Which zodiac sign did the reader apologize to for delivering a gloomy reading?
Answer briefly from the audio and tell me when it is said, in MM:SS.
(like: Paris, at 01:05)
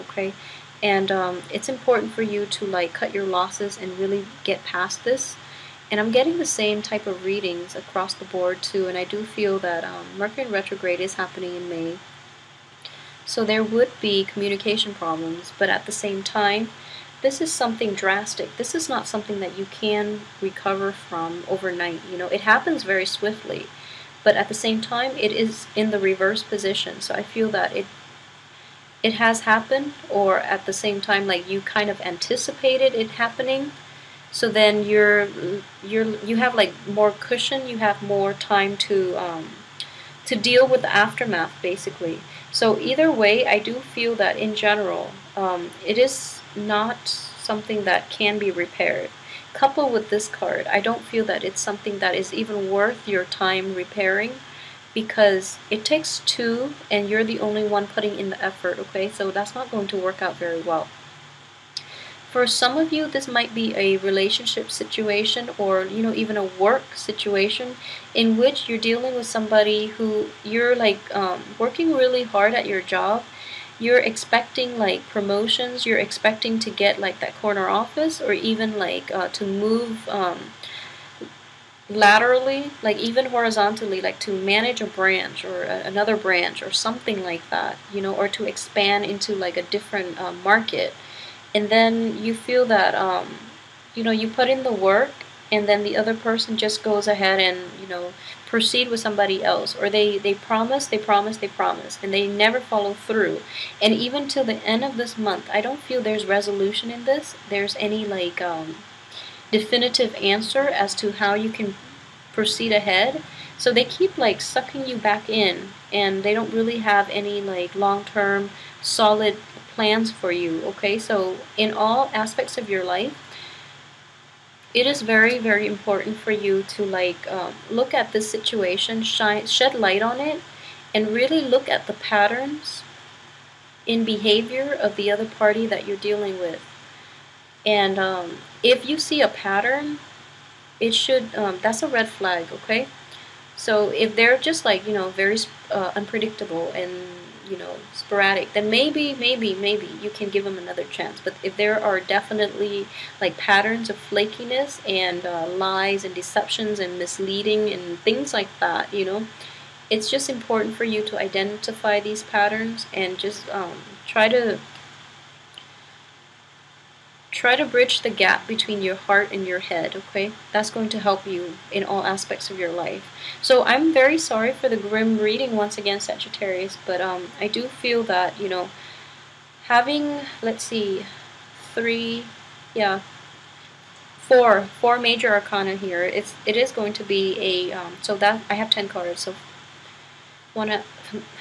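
Sagittarius, at 02:56.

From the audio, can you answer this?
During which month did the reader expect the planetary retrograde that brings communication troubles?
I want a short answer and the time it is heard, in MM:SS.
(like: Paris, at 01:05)
May, at 00:11.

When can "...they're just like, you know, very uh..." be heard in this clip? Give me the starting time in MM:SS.
02:24.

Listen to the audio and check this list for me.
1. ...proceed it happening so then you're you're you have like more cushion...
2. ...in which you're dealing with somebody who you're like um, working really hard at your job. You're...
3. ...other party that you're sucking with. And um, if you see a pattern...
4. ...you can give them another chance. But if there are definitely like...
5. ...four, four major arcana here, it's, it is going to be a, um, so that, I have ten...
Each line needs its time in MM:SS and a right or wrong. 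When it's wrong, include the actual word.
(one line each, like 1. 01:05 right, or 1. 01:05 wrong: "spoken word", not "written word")
1. 00:32 wrong: "anticipated", not "proceed"
2. 01:08 right
3. 02:15 wrong: "dealing", not "sucking"
4. 02:30 right
5. 03:04 right.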